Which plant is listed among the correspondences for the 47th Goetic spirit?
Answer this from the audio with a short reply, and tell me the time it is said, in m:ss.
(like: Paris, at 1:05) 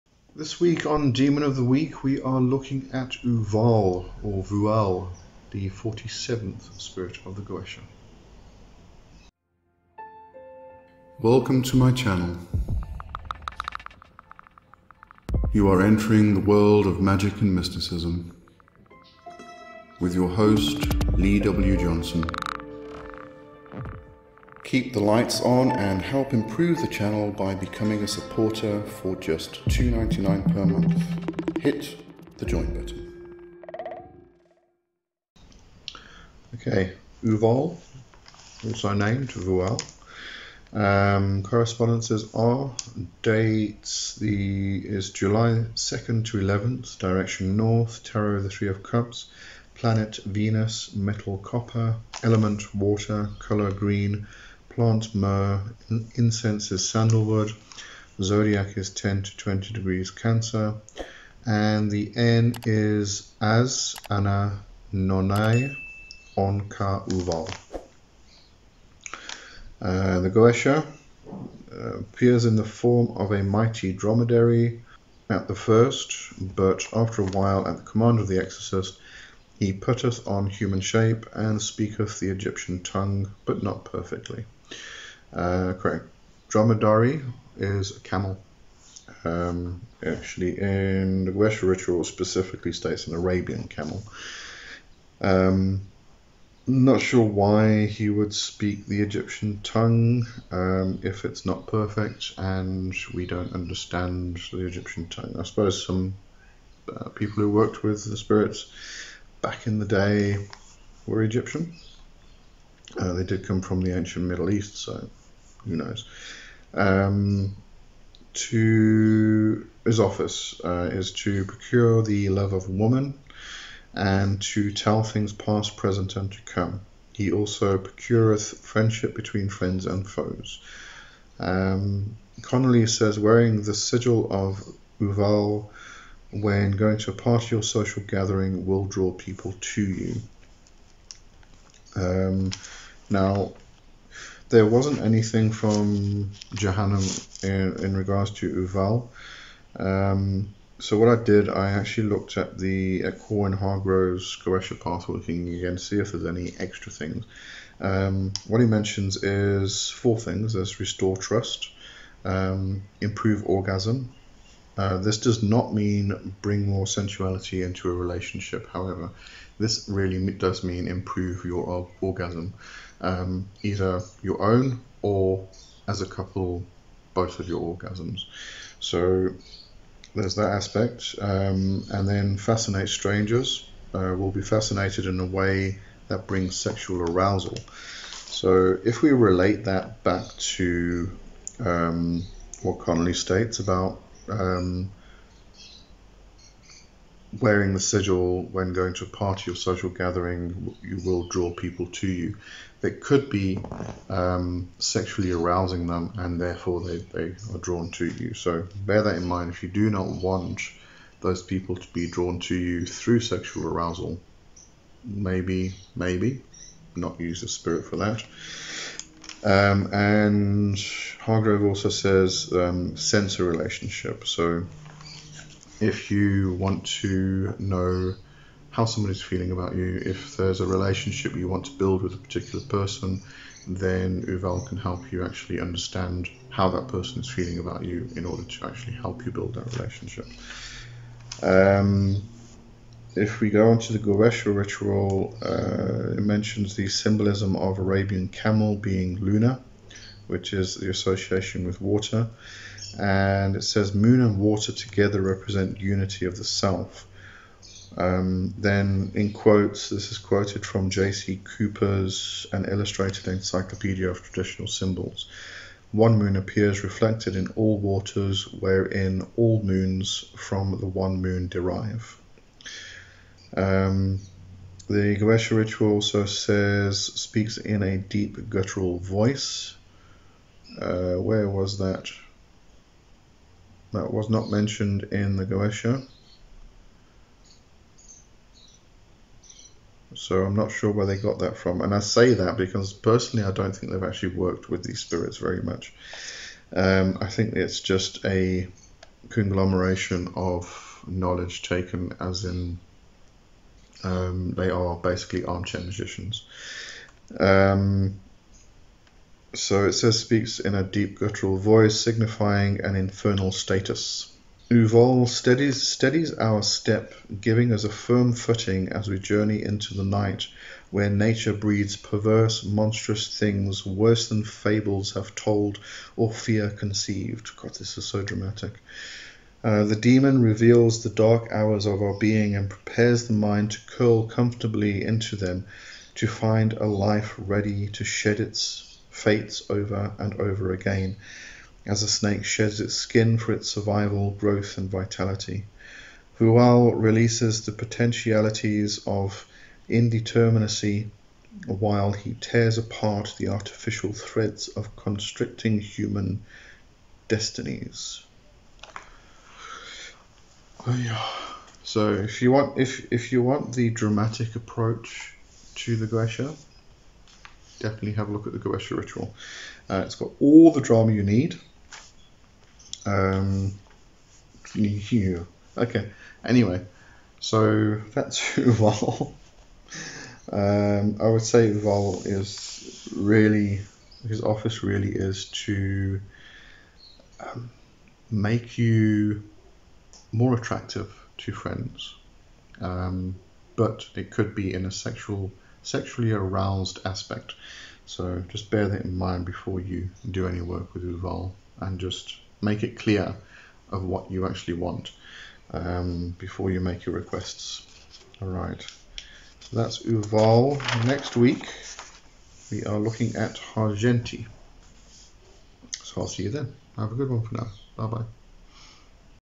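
myrrh, at 0:55.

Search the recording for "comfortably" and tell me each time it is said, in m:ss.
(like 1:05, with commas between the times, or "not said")
5:34.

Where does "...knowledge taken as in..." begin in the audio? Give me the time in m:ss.
5:01.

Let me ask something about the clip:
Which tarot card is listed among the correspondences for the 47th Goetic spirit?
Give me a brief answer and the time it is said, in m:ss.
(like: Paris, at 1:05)
Three of Cups, at 0:48.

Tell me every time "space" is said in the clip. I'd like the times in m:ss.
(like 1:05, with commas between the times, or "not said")
not said.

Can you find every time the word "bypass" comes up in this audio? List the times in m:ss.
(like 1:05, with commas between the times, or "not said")
not said.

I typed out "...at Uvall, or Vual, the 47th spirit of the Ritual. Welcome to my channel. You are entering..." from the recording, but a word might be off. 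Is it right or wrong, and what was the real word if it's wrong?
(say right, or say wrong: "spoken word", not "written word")
wrong: "Goetia", not "Ritual".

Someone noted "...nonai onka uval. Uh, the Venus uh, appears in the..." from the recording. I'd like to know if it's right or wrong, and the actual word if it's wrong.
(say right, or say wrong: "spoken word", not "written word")
wrong: "Goetia", not "Venus".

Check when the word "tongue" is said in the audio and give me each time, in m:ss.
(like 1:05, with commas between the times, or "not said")
1:22, 1:39, 1:45.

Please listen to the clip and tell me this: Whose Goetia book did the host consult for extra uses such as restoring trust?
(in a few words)
Corwin Hargrove.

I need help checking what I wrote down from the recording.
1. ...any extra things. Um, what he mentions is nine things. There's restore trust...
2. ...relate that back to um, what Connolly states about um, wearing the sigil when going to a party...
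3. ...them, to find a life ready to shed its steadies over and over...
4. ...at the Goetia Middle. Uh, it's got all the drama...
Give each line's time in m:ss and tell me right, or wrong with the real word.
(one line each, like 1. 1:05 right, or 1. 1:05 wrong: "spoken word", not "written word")
1. 2:36 wrong: "four", not "nine"
2. 3:09 right
3. 5:35 wrong: "fates", not "steadies"
4. 6:08 wrong: "Ritual", not "Middle".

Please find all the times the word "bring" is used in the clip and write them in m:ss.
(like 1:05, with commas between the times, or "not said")
2:46, 3:06.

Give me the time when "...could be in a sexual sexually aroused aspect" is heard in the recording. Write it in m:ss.
6:34.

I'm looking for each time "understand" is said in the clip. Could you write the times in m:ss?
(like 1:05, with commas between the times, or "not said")
1:43, 3:55.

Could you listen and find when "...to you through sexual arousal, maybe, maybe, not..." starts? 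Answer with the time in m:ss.
3:32.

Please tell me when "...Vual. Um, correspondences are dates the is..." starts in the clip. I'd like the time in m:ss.
0:39.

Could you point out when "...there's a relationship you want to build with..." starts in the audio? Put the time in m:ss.
3:50.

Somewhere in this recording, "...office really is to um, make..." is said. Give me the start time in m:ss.
6:24.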